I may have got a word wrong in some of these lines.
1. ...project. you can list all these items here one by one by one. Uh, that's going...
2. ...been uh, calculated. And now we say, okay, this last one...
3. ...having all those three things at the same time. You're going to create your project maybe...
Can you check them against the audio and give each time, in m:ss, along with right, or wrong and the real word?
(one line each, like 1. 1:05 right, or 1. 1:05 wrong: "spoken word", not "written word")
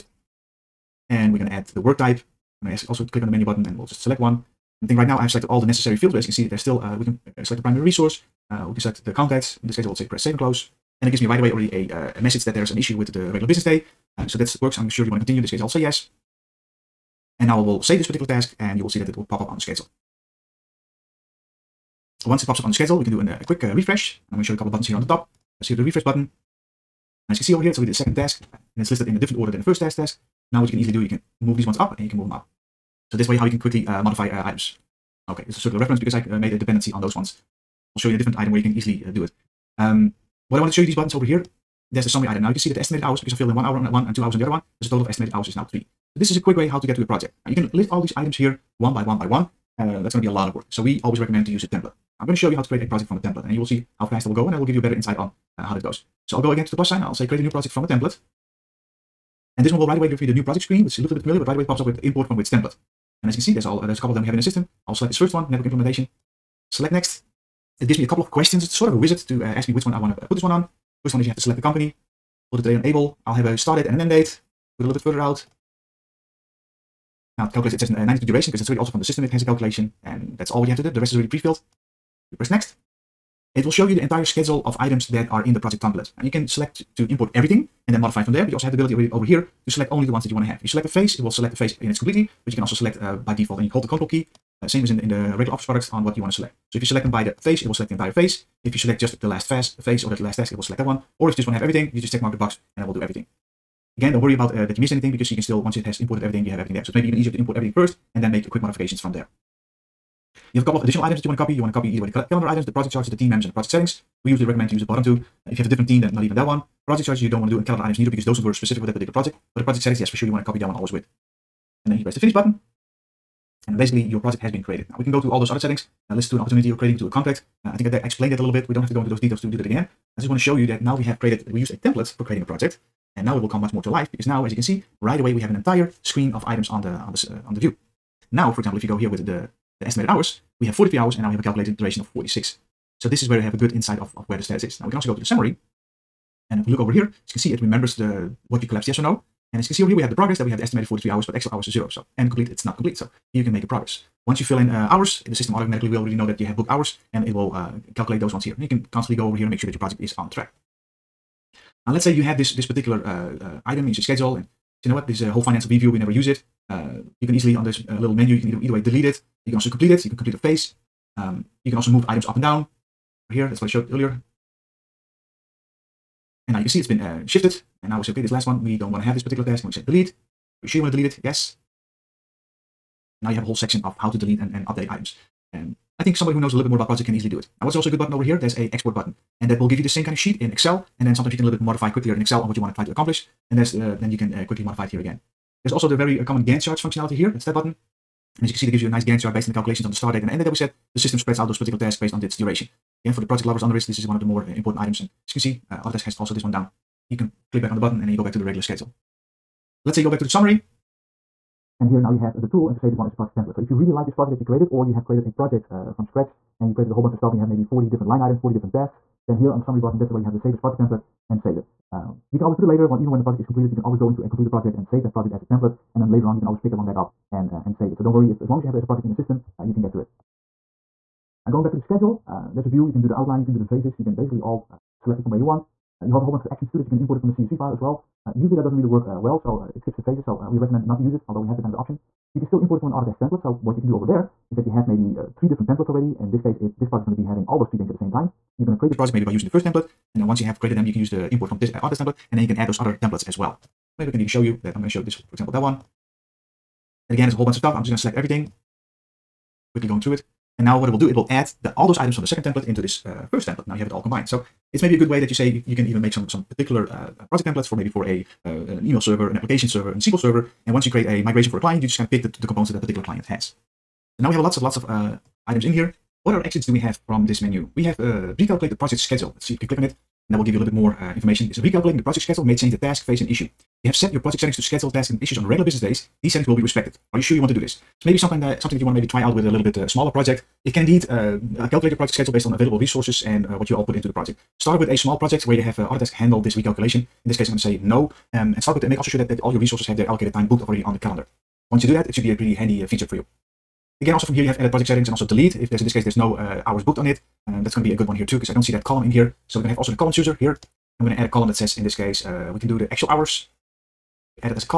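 1. 0:47 right
2. 2:56 wrong: "shifted", not "calculated"
3. 4:07 right.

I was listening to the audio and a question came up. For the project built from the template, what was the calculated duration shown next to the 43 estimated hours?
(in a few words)
46.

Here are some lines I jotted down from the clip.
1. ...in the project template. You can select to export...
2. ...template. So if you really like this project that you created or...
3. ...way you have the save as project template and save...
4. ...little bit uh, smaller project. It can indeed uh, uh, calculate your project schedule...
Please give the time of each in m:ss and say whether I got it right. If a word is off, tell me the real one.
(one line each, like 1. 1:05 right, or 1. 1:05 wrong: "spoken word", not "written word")
1. 1:25 wrong: "import", not "export"
2. 3:33 right
3. 3:40 right
4. 4:49 right.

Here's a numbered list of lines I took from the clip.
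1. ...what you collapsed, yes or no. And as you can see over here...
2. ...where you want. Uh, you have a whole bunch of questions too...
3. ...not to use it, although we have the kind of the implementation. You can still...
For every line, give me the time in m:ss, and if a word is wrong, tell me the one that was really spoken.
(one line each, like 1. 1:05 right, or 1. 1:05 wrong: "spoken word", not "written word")
1. 2:28 right
2. 3:55 wrong: "actions", not "questions"
3. 4:00 wrong: "option", not "implementation".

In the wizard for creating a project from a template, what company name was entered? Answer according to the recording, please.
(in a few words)
Able.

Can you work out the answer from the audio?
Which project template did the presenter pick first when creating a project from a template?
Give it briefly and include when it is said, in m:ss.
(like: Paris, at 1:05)
Network implementation, at 1:05.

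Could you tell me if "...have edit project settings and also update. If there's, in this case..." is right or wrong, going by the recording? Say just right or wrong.
wrong.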